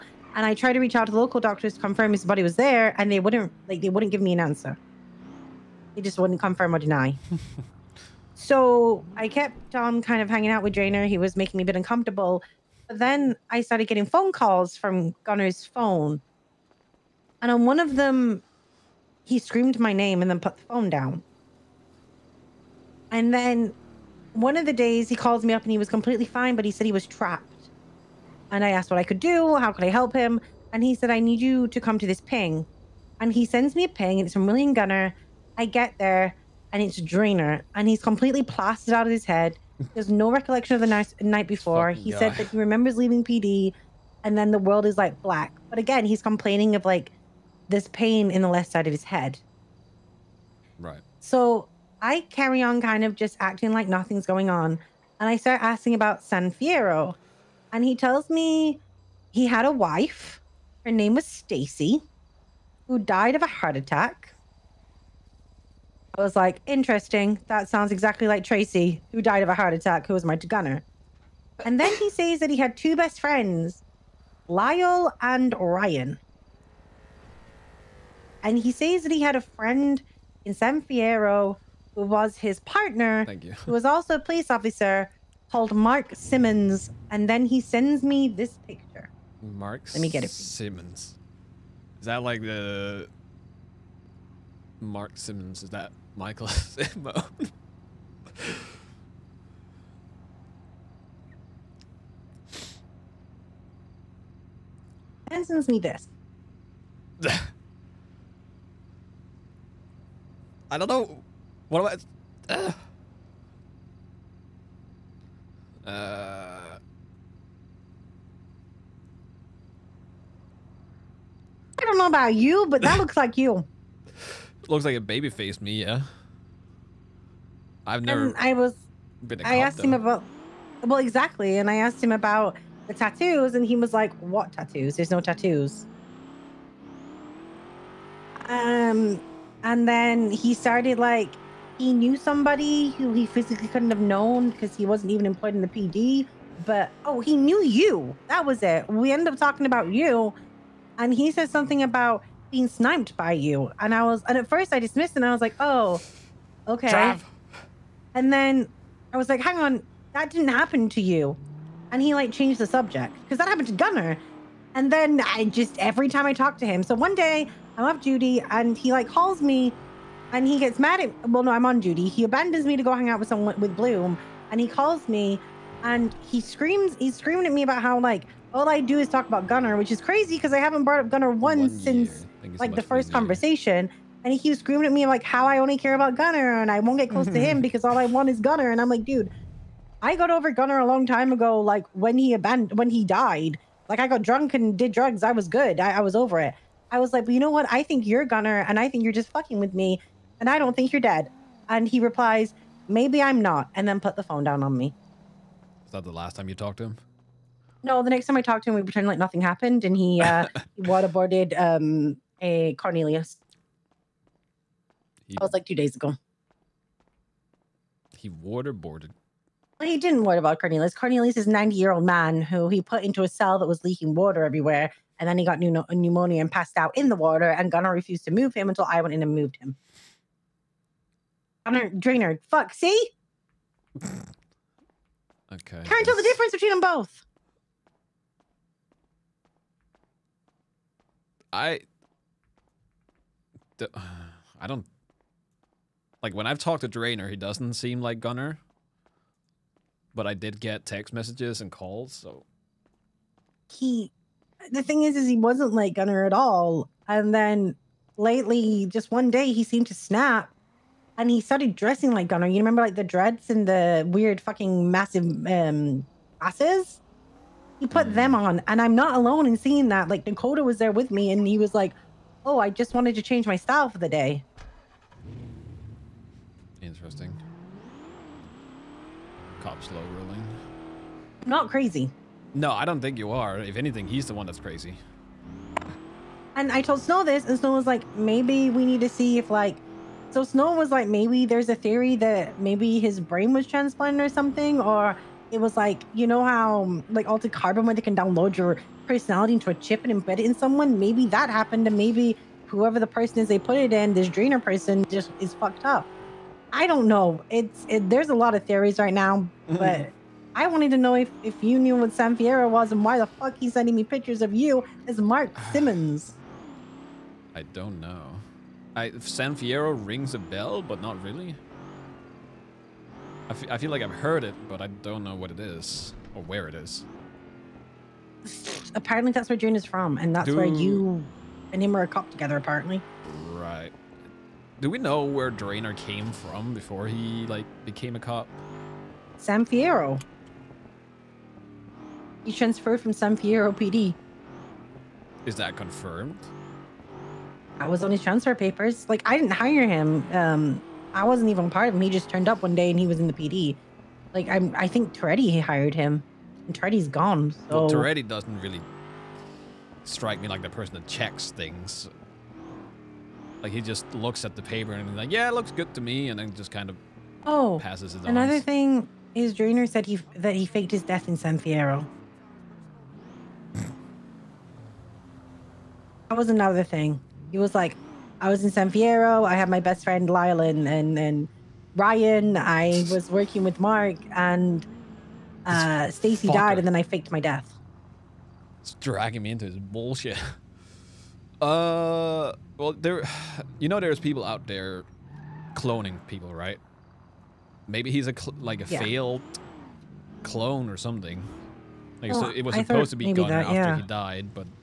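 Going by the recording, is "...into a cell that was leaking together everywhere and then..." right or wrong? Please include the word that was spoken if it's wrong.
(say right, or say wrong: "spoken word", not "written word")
wrong: "water", not "together".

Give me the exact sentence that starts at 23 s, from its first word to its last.
And then one of the days he calls me up and he was completely fine, but he said he was trapped.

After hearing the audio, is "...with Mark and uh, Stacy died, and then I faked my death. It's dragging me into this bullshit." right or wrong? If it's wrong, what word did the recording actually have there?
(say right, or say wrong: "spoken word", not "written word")
right.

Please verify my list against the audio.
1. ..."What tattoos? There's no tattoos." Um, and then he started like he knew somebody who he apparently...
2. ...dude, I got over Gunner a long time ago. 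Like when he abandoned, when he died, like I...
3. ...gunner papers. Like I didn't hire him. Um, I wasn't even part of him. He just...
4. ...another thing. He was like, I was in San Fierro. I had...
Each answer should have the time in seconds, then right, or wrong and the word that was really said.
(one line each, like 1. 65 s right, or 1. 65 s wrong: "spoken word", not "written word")
1. 134 s wrong: "physically", not "apparently"
2. 189 s right
3. 348 s wrong: "transfer", not "gunner"
4. 376 s right.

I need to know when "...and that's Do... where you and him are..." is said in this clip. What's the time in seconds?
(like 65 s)
330 s.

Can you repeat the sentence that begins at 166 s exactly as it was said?
So one day I love Judy, and he like calls me, and he gets mad at.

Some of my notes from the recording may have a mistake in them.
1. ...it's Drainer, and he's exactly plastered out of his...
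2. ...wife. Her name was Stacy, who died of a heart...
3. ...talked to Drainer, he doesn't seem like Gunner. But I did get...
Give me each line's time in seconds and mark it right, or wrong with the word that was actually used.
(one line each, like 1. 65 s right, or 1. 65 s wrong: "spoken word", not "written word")
1. 36 s wrong: "completely", not "exactly"
2. 59 s right
3. 246 s right.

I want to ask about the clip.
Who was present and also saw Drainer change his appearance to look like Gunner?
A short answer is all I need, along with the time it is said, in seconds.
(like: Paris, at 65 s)
Dakota, at 270 s.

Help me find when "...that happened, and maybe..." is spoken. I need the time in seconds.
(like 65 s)
301 s.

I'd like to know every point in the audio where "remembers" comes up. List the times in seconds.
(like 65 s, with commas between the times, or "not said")
42 s, 262 s.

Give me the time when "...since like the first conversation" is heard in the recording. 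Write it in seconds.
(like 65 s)
181 s.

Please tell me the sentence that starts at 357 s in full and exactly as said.
So well, Toretti doesn't really strike me like the person that checks things.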